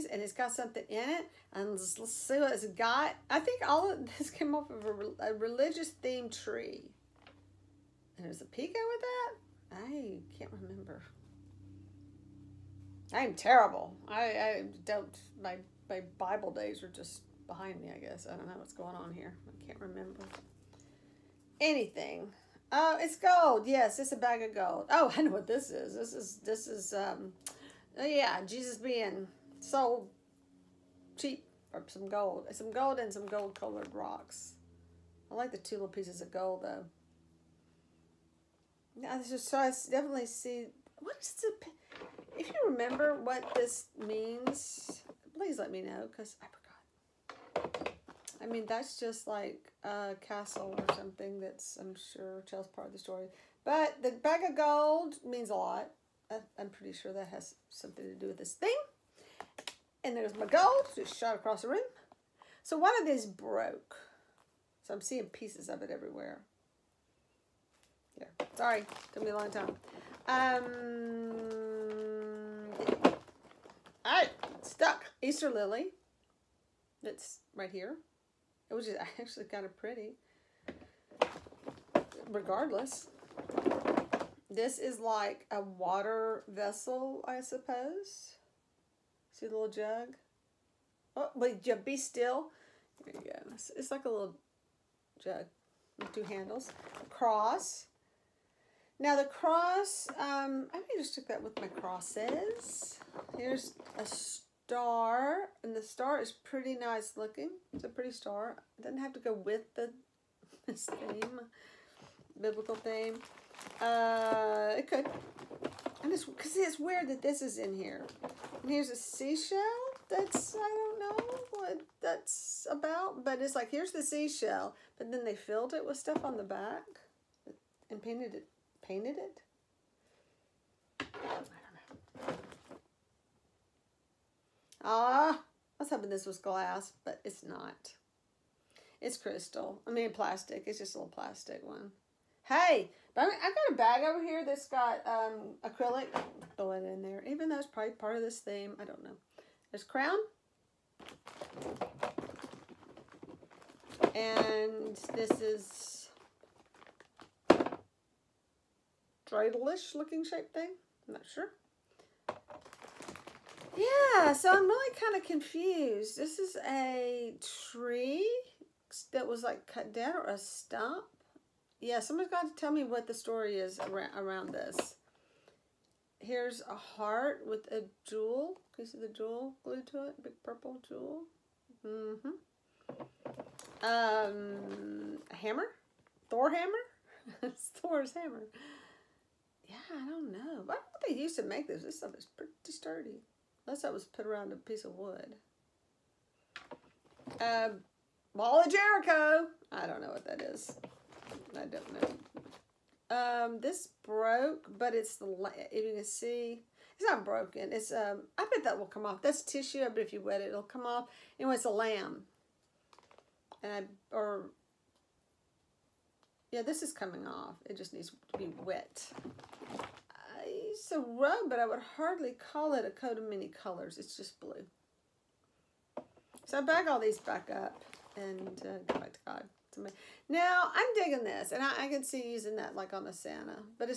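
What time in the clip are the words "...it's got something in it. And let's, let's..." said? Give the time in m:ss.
0:00.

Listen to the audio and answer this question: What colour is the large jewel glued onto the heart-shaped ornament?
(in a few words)
purple.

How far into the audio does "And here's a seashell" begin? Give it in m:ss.
1:58.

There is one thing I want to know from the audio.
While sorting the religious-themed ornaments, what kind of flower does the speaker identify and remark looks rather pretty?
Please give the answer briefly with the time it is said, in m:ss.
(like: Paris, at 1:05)
Easter lily, at 1:15.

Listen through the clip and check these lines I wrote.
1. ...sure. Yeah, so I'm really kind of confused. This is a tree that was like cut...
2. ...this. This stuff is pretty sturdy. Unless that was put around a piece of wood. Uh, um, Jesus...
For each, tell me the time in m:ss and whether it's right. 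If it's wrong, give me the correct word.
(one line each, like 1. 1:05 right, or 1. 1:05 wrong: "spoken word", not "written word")
1. 2:41 right
2. 3:11 wrong: "Ball", not "Jesus".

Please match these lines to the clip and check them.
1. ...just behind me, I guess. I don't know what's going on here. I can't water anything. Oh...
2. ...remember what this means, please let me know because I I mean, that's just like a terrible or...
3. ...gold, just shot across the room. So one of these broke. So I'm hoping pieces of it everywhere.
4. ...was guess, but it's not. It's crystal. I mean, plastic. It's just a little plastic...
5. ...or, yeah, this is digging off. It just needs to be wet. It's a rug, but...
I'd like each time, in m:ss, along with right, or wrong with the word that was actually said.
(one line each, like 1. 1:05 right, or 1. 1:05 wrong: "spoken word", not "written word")
1. 0:16 wrong: "remember", not "water"
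2. 0:42 wrong: "castle", not "terrible"
3. 1:00 wrong: "seeing", not "hoping"
4. 2:16 wrong: "glass", not "guess"
5. 3:34 wrong: "coming", not "digging".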